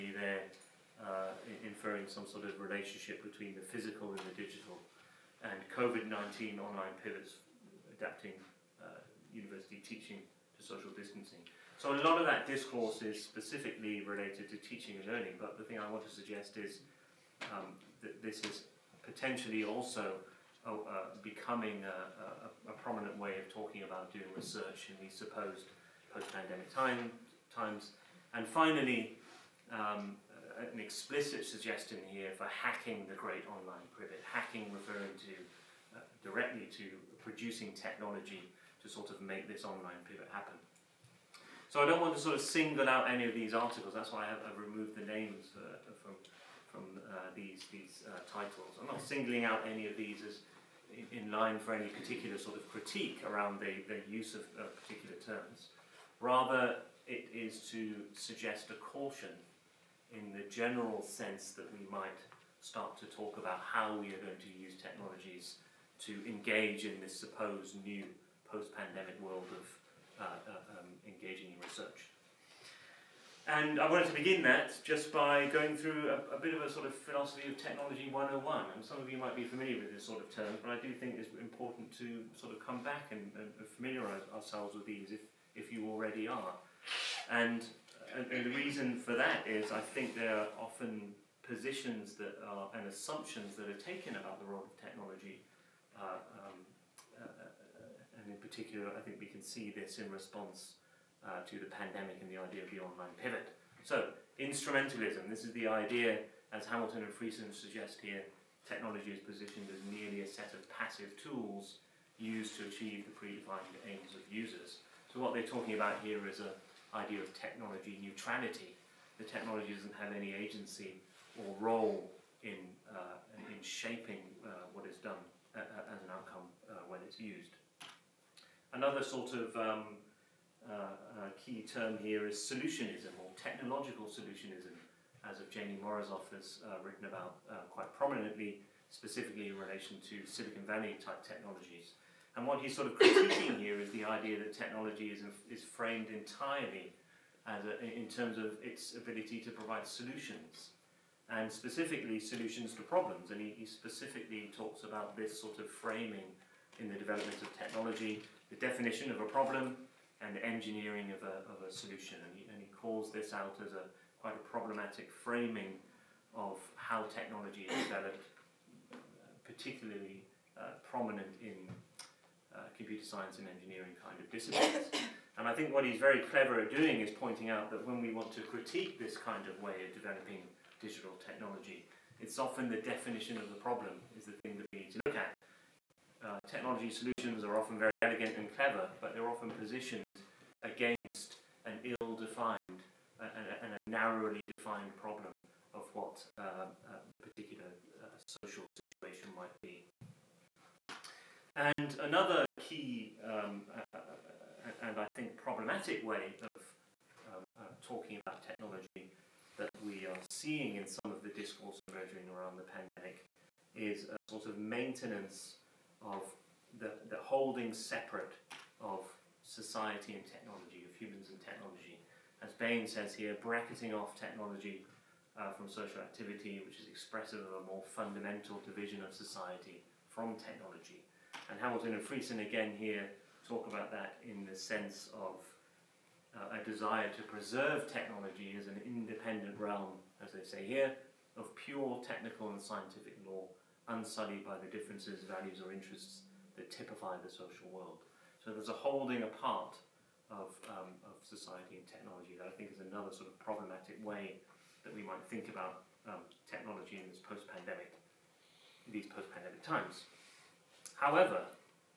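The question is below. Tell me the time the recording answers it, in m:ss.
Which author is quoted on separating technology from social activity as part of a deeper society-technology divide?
3:42.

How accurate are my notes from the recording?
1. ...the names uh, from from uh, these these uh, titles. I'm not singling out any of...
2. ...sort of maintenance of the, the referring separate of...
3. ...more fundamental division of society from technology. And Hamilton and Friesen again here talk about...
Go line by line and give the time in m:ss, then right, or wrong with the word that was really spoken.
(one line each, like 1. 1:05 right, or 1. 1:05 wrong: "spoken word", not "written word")
1. 0:44 right
2. 3:34 wrong: "holding", not "referring"
3. 3:47 right.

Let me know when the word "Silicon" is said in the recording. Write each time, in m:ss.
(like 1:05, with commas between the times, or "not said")
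2:20.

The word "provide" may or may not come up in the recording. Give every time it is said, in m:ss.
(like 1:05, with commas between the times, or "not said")
2:29.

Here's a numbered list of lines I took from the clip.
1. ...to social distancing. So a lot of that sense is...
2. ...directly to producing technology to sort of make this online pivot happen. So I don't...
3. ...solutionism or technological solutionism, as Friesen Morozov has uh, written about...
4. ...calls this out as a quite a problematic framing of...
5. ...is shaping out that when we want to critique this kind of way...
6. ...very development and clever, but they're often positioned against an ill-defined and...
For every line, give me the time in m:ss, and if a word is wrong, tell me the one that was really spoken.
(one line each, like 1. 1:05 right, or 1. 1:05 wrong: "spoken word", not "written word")
1. 0:10 wrong: "discourse", not "sense"
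2. 0:36 right
3. 2:12 wrong: "Evgeny", not "Friesen"
4. 2:42 right
5. 2:56 wrong: "pointing", not "shaping"
6. 3:07 wrong: "elegant", not "development".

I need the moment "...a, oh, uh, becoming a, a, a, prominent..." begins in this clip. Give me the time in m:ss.
0:20.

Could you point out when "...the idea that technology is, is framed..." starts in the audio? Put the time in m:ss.
2:23.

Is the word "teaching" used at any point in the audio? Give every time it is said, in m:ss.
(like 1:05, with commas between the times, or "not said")
0:09, 0:14.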